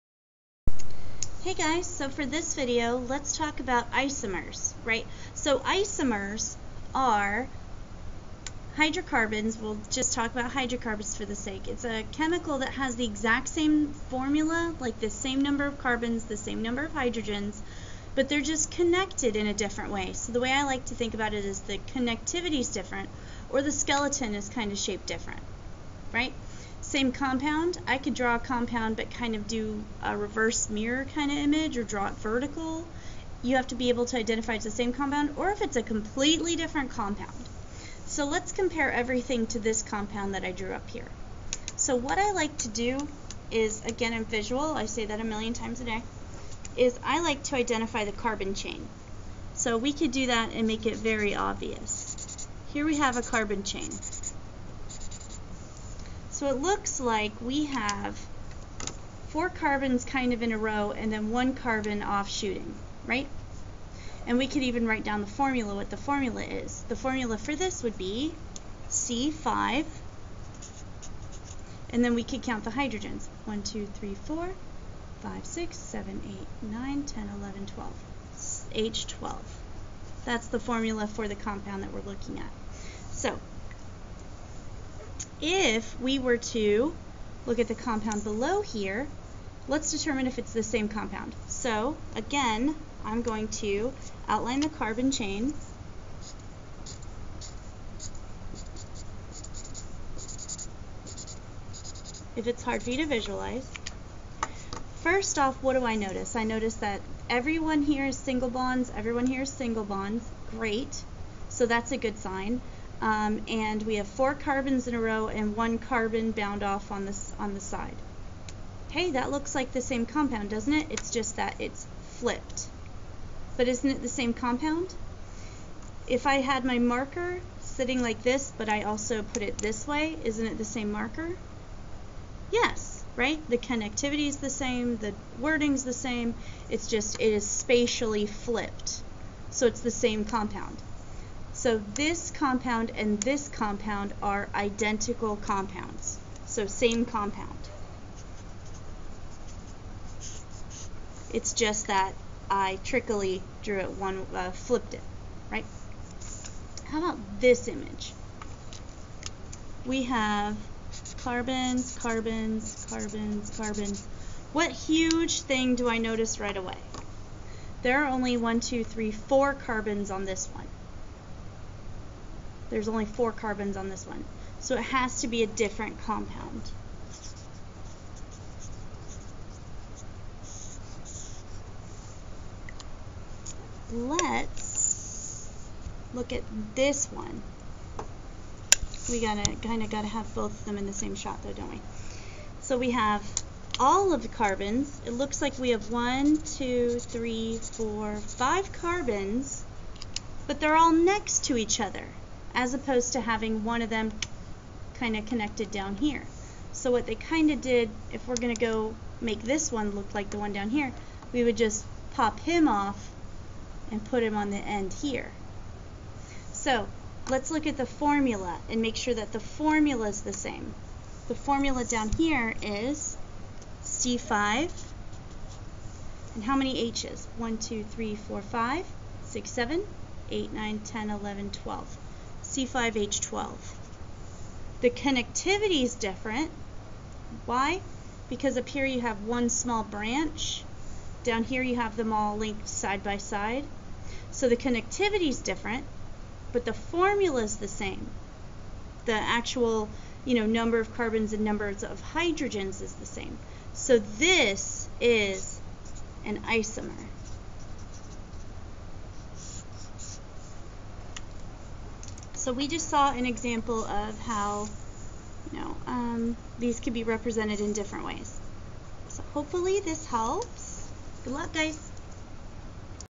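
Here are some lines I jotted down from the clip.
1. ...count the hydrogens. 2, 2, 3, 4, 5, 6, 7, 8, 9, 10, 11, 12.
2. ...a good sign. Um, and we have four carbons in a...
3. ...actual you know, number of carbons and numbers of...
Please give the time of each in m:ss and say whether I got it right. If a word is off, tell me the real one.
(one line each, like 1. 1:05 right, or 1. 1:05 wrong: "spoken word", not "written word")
1. 1:12 wrong: "1", not "2"
2. 1:51 right
3. 4:09 right.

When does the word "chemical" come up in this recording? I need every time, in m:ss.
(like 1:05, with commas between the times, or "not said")
0:12.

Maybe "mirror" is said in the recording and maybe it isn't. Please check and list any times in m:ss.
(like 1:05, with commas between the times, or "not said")
0:30.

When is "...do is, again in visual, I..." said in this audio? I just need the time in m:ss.
0:42.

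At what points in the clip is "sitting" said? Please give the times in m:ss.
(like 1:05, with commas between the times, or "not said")
2:07.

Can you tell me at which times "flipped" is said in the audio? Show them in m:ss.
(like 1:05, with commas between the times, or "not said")
2:02, 2:18, 2:34.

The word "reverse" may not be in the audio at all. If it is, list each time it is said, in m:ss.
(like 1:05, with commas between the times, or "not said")
0:30.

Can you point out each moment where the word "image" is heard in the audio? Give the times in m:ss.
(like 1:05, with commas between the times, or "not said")
0:31, 2:37.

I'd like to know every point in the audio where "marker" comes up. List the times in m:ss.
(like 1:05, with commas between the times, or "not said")
2:06, 2:10.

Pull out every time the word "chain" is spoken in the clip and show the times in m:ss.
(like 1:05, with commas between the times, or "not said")
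0:48, 0:53, 1:35.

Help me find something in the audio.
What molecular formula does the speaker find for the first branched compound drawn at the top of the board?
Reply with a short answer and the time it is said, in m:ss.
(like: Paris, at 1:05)
C5H12, at 1:08.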